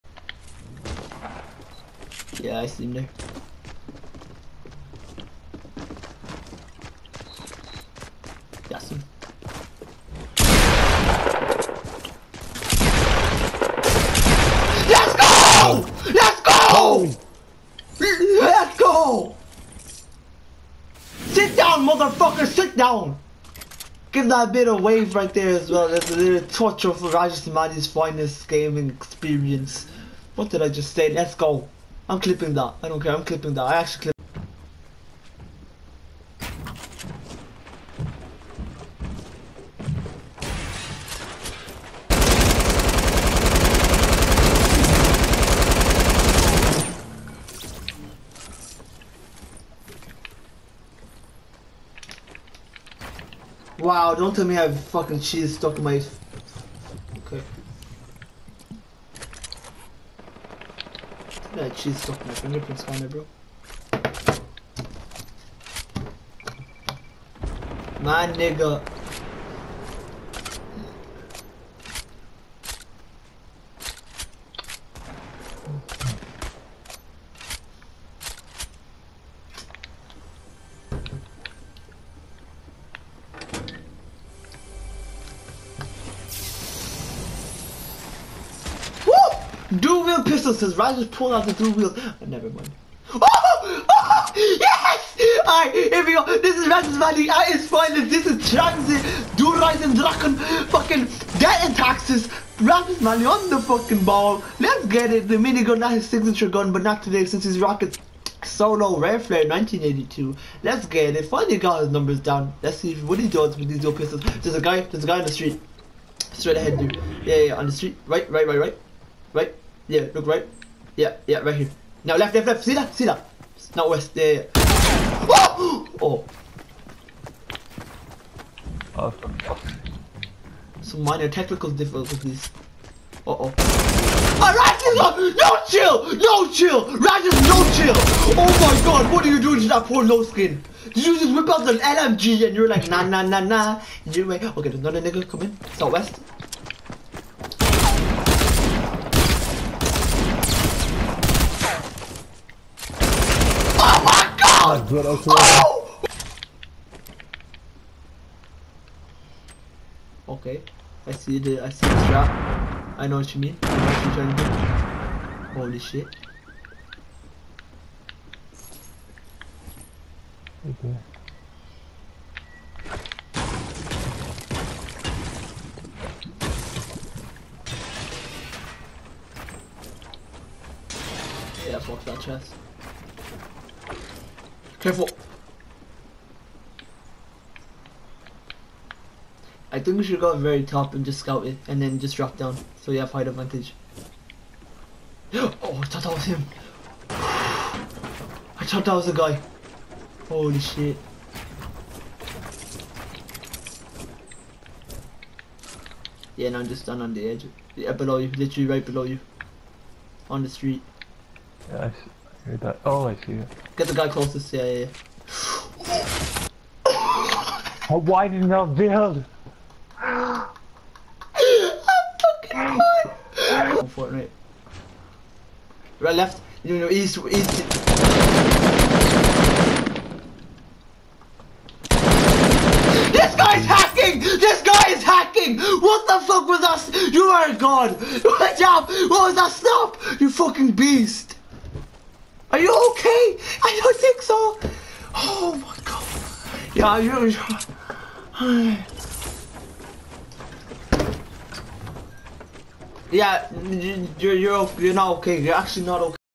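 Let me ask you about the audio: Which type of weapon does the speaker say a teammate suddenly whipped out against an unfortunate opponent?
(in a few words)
LMG.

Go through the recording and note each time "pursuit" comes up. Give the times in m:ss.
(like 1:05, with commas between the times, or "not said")
not said.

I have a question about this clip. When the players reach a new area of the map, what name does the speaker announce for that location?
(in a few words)
Ryder's Valley.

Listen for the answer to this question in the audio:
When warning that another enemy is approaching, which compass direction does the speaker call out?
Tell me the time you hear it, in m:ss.
2:25.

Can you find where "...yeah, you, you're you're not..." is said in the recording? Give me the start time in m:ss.
4:13.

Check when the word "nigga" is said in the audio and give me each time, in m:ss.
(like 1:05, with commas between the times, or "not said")
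1:08, 2:25.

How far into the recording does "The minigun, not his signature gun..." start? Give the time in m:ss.
1:45.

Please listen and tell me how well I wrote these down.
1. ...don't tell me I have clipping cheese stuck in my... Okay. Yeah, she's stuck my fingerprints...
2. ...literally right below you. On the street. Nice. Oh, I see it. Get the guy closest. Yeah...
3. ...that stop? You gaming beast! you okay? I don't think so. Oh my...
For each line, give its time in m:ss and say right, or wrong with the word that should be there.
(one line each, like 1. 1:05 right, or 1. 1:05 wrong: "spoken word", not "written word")
1. 0:54 wrong: "fucking", not "clipping"
2. 3:28 right
3. 3:59 wrong: "fucking", not "gaming".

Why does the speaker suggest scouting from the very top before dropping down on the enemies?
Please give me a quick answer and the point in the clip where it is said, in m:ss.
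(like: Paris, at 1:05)
Height advantage, at 3:13.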